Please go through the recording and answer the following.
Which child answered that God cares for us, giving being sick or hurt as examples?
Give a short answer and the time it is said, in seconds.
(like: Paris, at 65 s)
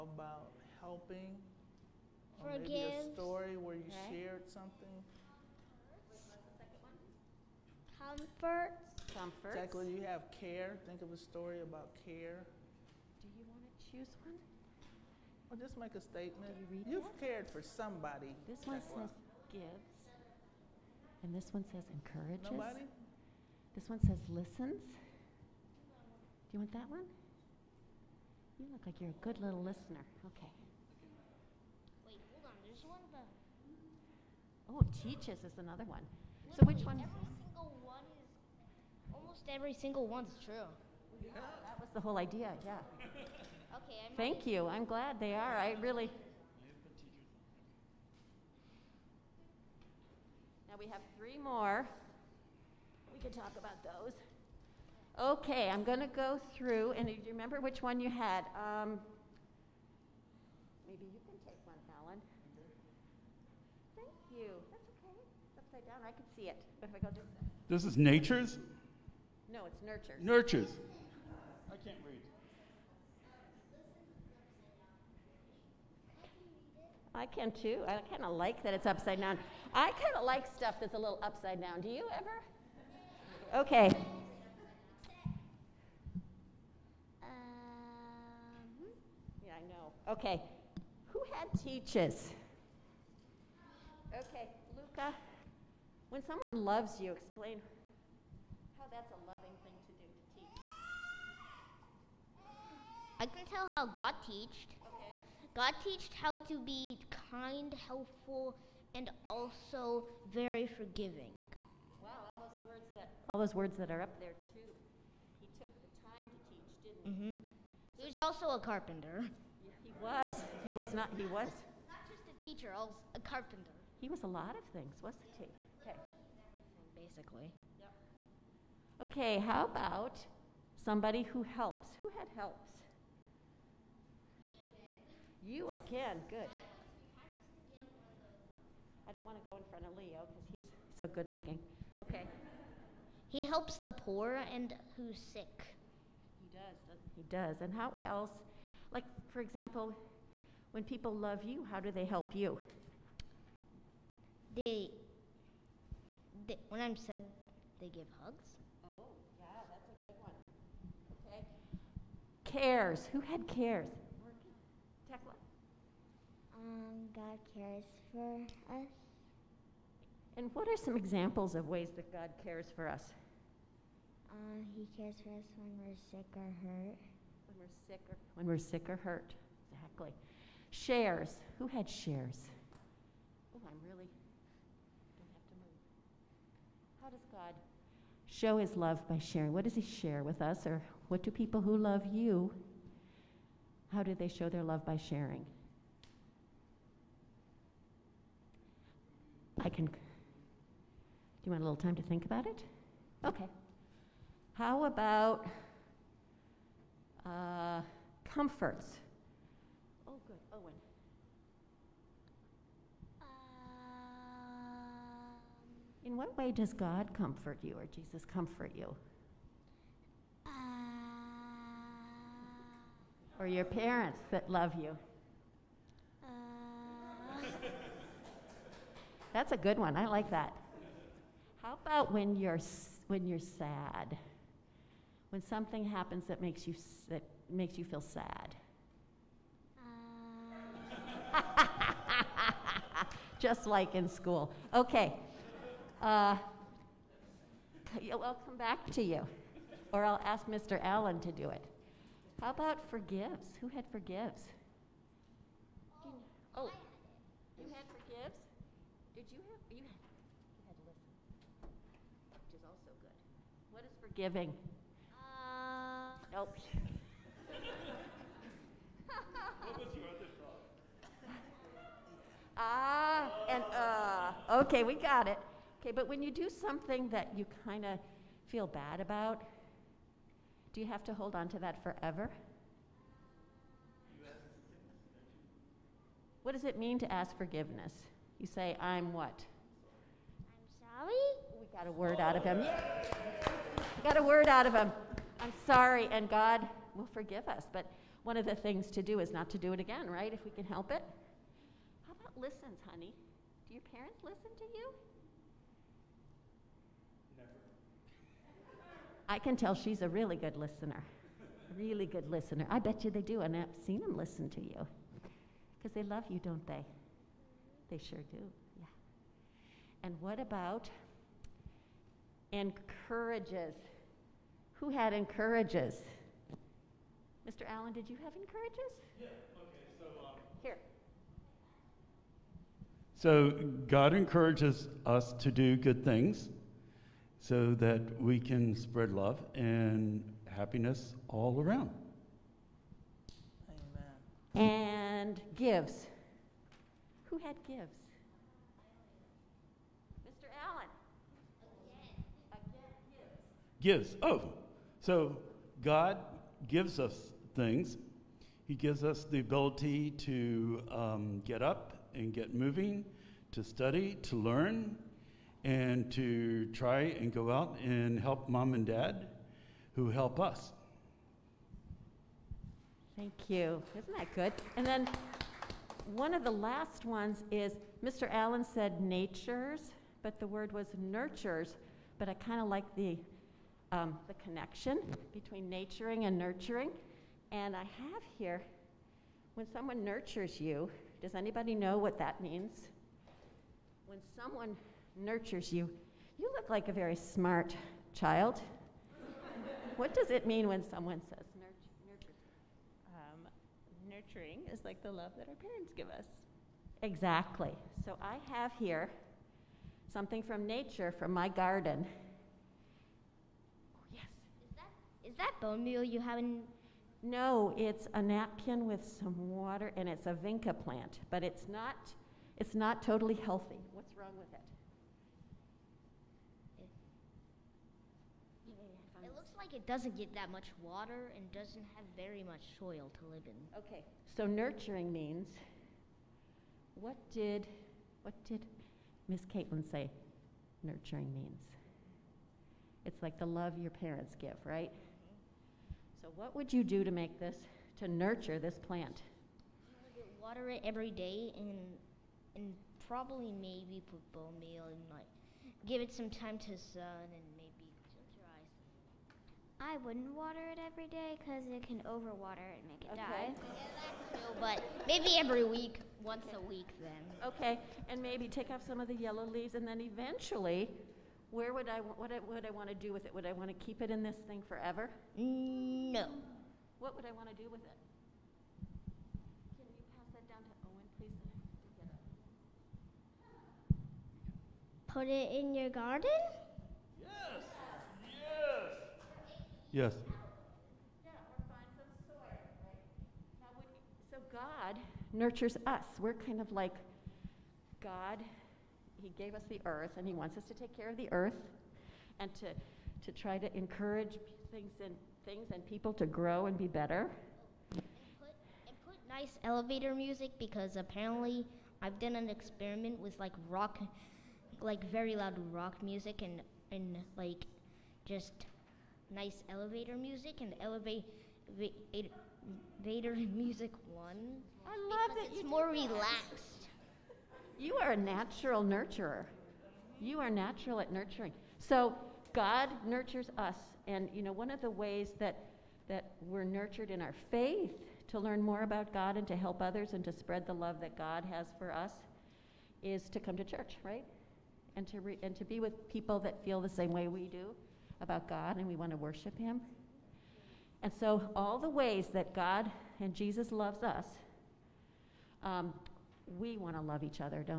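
Tekla, at 165 s.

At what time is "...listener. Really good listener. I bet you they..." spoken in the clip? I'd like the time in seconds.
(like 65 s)
310 s.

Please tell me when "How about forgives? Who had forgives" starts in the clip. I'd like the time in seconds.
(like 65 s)
252 s.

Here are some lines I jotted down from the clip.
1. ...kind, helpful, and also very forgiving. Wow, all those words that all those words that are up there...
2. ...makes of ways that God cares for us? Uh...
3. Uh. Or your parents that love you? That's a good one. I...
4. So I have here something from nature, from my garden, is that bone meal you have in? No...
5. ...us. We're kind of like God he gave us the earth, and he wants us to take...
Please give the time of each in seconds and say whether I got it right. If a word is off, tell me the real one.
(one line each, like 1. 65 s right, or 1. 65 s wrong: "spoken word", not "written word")
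1. 107 s right
2. 170 s wrong: "examples", not "makes"
3. 220 s right
4. 408 s right
5. 495 s right.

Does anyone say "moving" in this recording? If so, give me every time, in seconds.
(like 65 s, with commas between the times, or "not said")
362 s.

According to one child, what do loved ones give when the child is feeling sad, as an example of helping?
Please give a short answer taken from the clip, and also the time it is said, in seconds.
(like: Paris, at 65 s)
hugs, at 158 s.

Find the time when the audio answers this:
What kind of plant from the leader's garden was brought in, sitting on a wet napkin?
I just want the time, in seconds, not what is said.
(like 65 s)
420 s.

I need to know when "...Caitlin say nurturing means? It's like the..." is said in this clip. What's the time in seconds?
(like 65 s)
439 s.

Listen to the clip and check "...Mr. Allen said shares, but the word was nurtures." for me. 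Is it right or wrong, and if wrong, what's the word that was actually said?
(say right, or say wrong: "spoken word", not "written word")
wrong: "natures", not "shares".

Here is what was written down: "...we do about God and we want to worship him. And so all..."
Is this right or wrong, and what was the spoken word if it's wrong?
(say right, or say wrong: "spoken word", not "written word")
right.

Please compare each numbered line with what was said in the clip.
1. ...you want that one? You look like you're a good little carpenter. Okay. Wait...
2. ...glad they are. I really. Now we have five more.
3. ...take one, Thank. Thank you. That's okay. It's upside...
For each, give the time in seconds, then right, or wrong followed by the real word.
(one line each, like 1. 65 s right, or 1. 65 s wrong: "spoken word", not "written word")
1. 26 s wrong: "listener", not "carpenter"
2. 44 s wrong: "three", not "five"
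3. 61 s wrong: "Alan", not "Thank".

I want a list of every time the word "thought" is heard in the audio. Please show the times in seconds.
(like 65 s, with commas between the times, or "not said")
270 s.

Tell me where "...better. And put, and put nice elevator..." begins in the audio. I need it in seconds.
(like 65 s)
506 s.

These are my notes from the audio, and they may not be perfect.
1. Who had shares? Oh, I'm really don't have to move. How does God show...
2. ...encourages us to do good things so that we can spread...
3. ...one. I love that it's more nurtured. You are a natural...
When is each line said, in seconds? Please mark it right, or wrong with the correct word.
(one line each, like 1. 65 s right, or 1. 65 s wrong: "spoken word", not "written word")
1. 181 s right
2. 334 s right
3. 524 s wrong: "relaxed", not "nurtured".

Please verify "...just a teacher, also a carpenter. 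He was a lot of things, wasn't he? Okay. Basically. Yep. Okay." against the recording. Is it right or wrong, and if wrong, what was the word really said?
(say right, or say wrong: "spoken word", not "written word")
right.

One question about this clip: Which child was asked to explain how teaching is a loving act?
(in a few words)
Luca.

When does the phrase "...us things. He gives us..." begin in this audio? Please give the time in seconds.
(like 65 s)
356 s.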